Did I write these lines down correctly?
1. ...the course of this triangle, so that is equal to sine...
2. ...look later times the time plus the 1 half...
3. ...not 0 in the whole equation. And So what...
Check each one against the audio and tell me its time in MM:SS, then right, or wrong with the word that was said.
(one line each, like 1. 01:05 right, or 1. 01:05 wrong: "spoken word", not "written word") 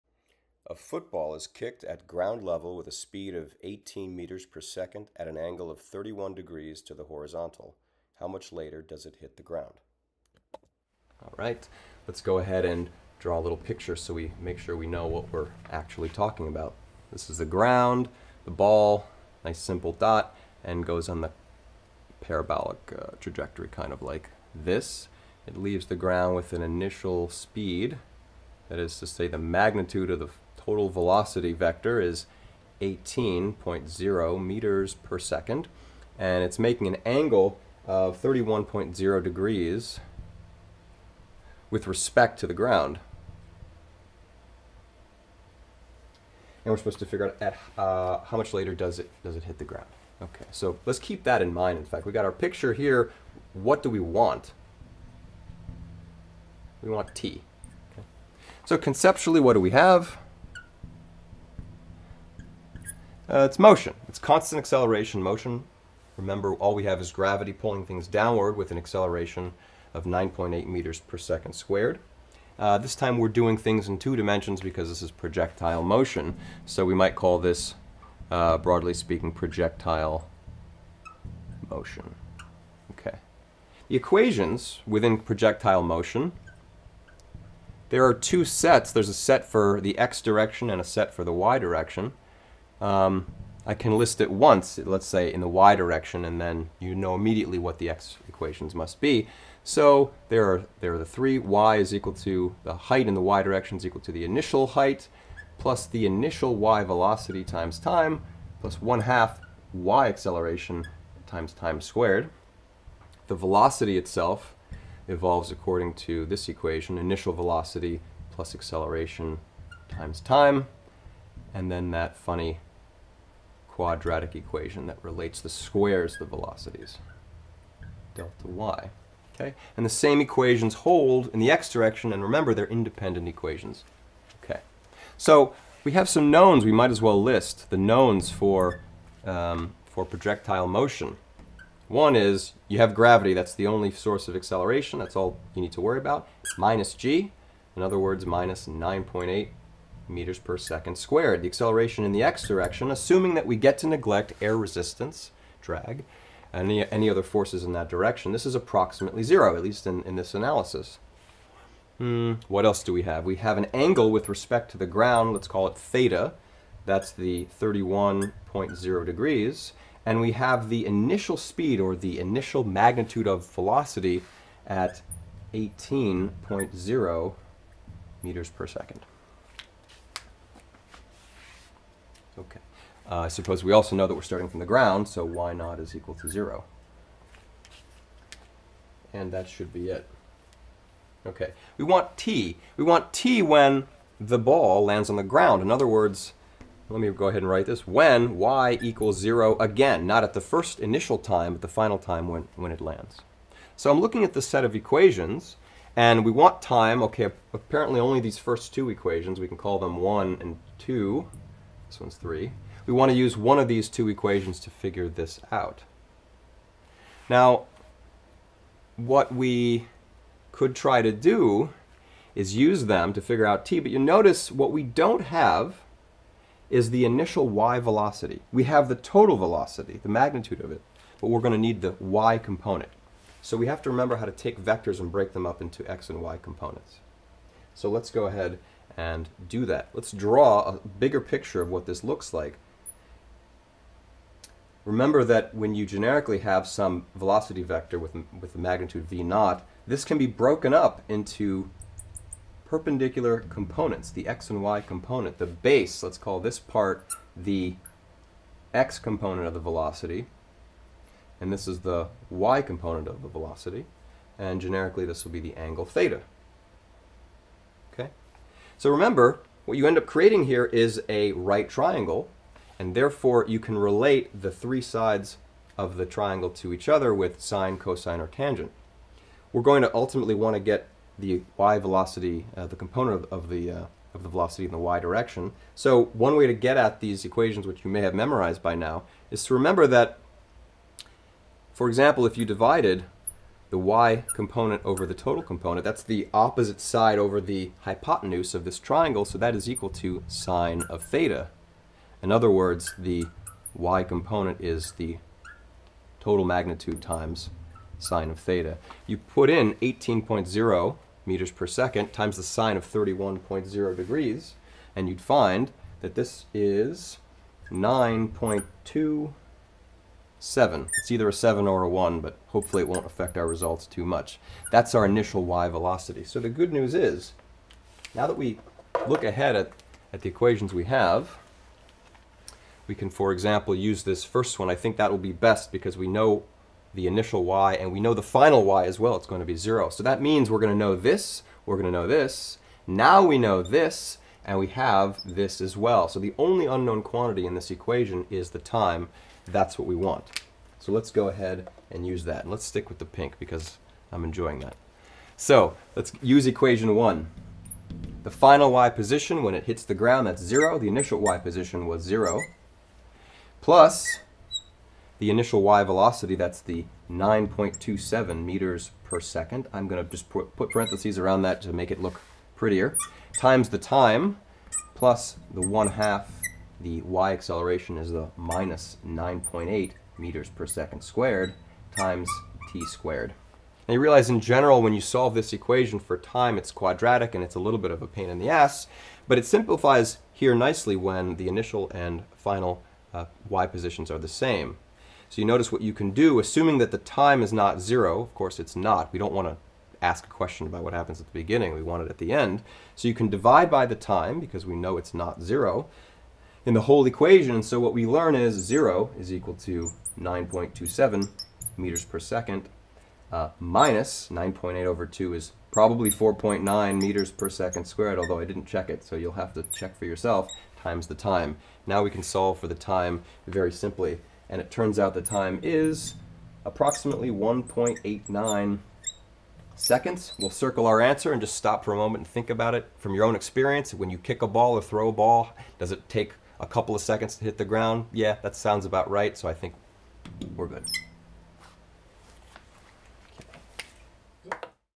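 1. 04:57 wrong: "hypotenuse", not "course"
2. 06:12 wrong: "prettier", not "later"
3. 06:45 right.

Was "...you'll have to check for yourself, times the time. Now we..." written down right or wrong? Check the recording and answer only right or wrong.
right.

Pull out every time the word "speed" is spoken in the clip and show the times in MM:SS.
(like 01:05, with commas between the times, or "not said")
00:02, 00:27, 02:51.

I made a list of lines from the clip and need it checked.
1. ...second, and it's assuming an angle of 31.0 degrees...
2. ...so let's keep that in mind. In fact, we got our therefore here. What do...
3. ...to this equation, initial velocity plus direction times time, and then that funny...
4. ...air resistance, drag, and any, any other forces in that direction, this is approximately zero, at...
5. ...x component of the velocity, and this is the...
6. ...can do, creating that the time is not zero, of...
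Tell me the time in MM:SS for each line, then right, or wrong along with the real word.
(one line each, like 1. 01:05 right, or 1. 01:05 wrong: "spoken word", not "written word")
1. 00:35 wrong: "making", not "assuming"
2. 00:50 wrong: "picture", not "therefore"
3. 01:56 wrong: "acceleration", not "direction"
4. 02:34 right
5. 04:18 right
6. 06:35 wrong: "assuming", not "creating".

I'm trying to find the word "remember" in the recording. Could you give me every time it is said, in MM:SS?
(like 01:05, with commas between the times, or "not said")
01:06, 02:12, 03:53, 04:04, 04:28, 04:49.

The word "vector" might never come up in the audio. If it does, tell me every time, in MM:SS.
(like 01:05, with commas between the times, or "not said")
00:31, 03:54, 04:07.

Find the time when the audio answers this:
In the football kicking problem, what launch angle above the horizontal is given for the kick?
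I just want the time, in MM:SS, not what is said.
00:05.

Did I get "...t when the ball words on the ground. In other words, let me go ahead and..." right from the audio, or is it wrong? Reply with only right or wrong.
wrong.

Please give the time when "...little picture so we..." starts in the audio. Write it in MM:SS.
00:13.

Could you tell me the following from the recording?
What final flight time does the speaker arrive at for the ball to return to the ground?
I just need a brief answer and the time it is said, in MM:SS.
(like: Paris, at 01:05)
1.89 seconds, at 07:07.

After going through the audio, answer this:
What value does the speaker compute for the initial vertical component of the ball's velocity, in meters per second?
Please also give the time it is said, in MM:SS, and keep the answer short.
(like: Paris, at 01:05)
9.27, at 05:17.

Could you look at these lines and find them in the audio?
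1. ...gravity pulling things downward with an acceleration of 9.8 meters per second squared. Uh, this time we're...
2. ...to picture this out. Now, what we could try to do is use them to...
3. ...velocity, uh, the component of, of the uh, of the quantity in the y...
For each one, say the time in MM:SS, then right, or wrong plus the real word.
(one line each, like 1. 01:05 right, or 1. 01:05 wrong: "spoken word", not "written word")
1. 01:07 right
2. 03:34 wrong: "figure", not "picture"
3. 04:41 wrong: "velocity", not "quantity".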